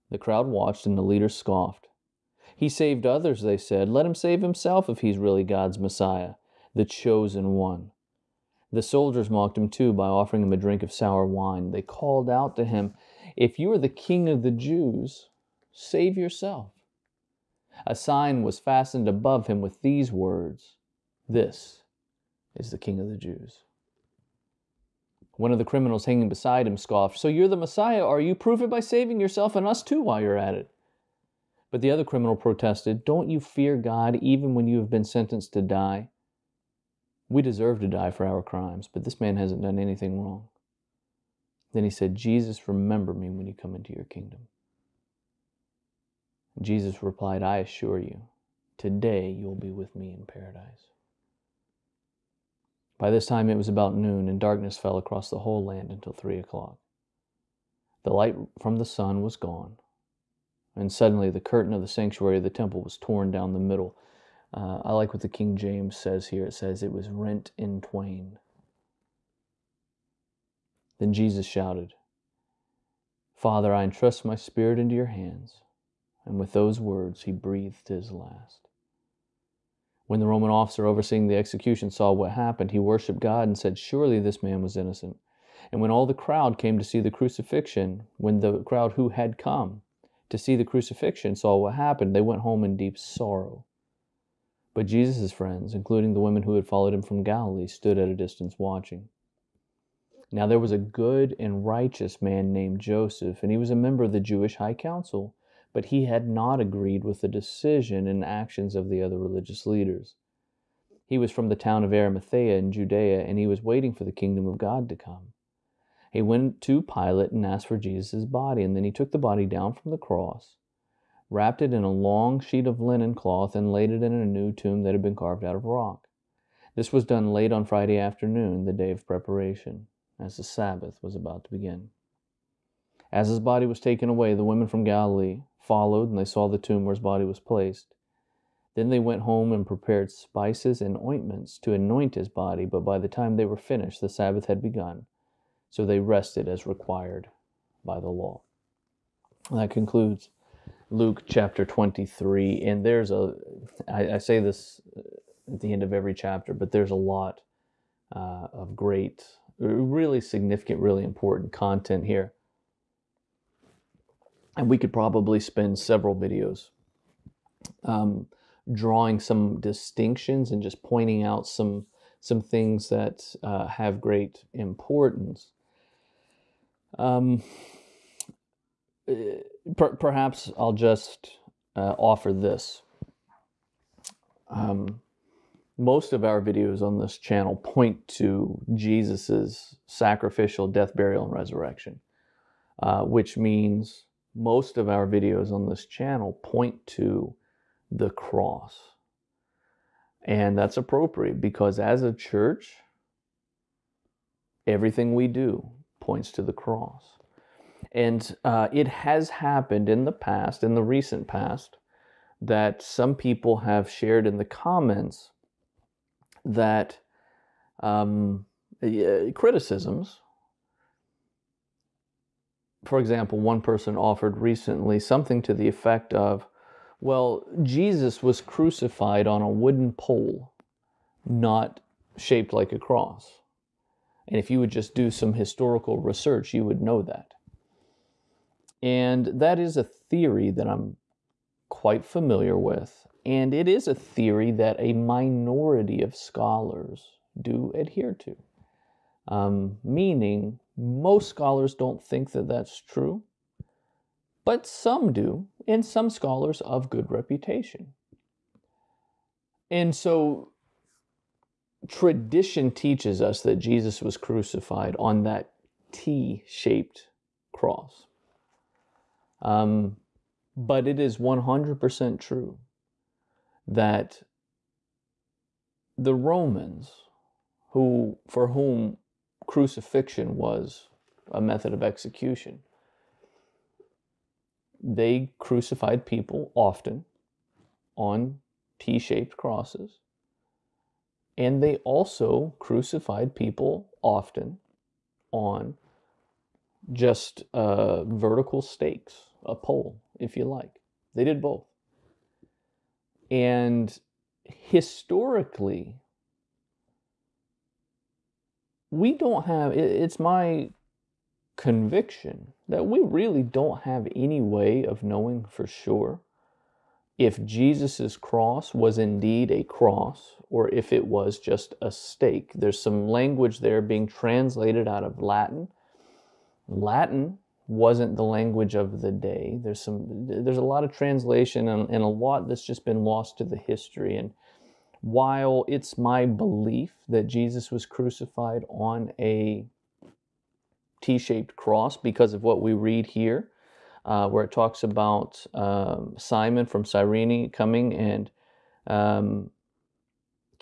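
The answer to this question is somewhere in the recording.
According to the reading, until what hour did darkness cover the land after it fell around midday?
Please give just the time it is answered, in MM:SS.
00:56.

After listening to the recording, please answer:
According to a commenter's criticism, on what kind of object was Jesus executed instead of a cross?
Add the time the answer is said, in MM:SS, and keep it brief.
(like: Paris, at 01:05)
wooden pole, at 03:49.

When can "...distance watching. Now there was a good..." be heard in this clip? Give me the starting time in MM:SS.
01:38.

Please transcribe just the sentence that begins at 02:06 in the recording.
This was done late on Friday afternoon, the day of preparation, as the Sabbath was about to begin.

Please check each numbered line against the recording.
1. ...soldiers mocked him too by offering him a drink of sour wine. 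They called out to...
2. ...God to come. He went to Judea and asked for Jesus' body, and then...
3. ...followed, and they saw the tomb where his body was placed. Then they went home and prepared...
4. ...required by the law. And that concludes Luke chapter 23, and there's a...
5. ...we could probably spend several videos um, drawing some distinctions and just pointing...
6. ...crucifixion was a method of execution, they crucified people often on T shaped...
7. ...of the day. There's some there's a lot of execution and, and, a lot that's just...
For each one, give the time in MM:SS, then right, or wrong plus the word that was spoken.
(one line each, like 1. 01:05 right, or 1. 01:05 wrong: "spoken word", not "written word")
1. 00:08 right
2. 01:54 wrong: "Pilate", not "Judea"
3. 02:15 right
4. 02:26 right
5. 02:44 right
6. 04:39 right
7. 05:28 wrong: "translation", not "execution".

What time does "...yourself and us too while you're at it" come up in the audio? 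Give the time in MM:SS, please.
00:29.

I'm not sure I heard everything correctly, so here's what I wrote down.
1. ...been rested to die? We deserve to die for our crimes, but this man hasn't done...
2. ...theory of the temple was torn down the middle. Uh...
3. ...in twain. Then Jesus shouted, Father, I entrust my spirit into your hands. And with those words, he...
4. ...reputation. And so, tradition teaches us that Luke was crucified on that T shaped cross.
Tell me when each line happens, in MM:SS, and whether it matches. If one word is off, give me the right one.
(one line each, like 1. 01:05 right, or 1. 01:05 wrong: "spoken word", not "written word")
1. 00:34 wrong: "sentenced", not "rested"
2. 01:01 wrong: "sanctuary", not "theory"
3. 01:07 right
4. 04:17 wrong: "Jesus", not "Luke".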